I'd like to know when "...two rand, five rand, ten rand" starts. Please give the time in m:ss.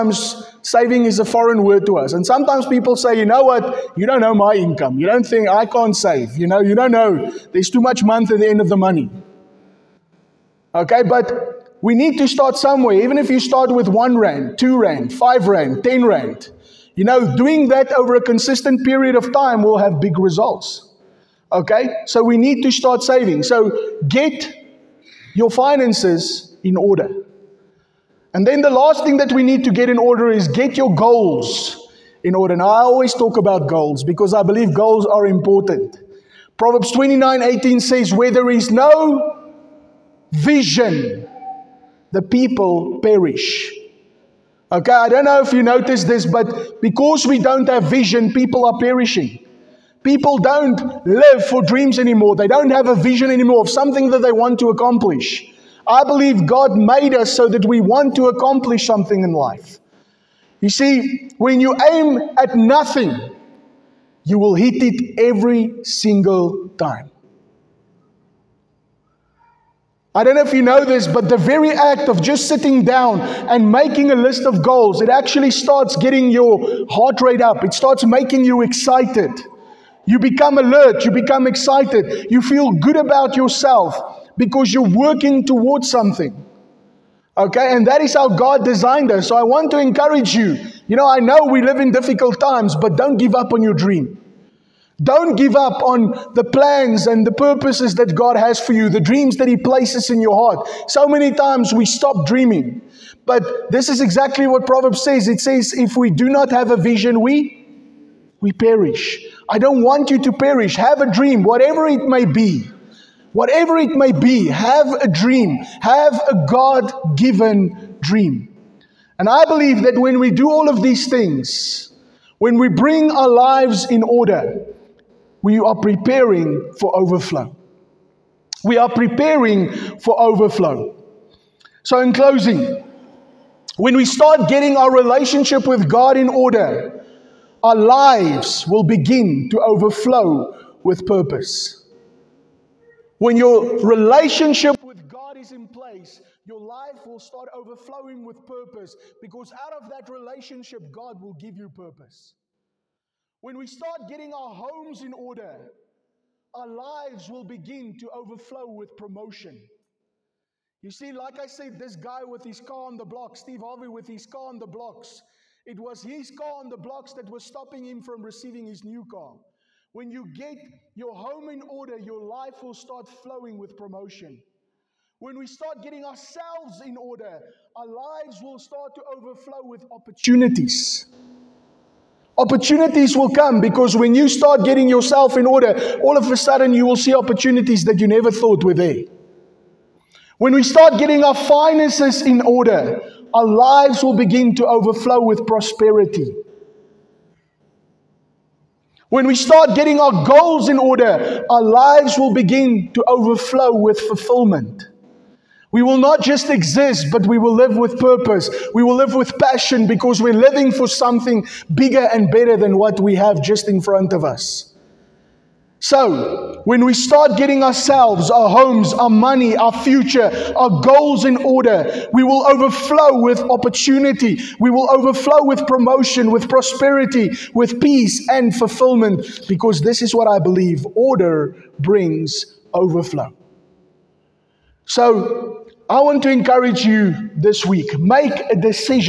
0:14.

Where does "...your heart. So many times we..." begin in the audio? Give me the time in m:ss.
1:40.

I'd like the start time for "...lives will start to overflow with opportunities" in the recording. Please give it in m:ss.
2:57.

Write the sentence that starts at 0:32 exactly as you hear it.
Now, I always talk about goals because I believe goals are important.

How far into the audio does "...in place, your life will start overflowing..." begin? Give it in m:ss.
2:25.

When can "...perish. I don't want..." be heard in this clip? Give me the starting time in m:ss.
1:48.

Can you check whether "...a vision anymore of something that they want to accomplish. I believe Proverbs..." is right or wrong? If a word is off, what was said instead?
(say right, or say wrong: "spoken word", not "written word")
wrong: "God", not "Proverbs".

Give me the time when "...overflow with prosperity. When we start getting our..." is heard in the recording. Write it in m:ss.
3:14.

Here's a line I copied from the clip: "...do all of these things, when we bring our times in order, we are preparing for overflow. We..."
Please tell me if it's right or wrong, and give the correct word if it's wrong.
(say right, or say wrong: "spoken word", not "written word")
wrong: "lives", not "times".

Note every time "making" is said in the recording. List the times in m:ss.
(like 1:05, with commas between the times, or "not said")
1:13, 1:18.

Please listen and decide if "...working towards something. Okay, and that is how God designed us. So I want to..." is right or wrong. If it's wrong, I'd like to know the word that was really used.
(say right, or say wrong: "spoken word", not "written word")
right.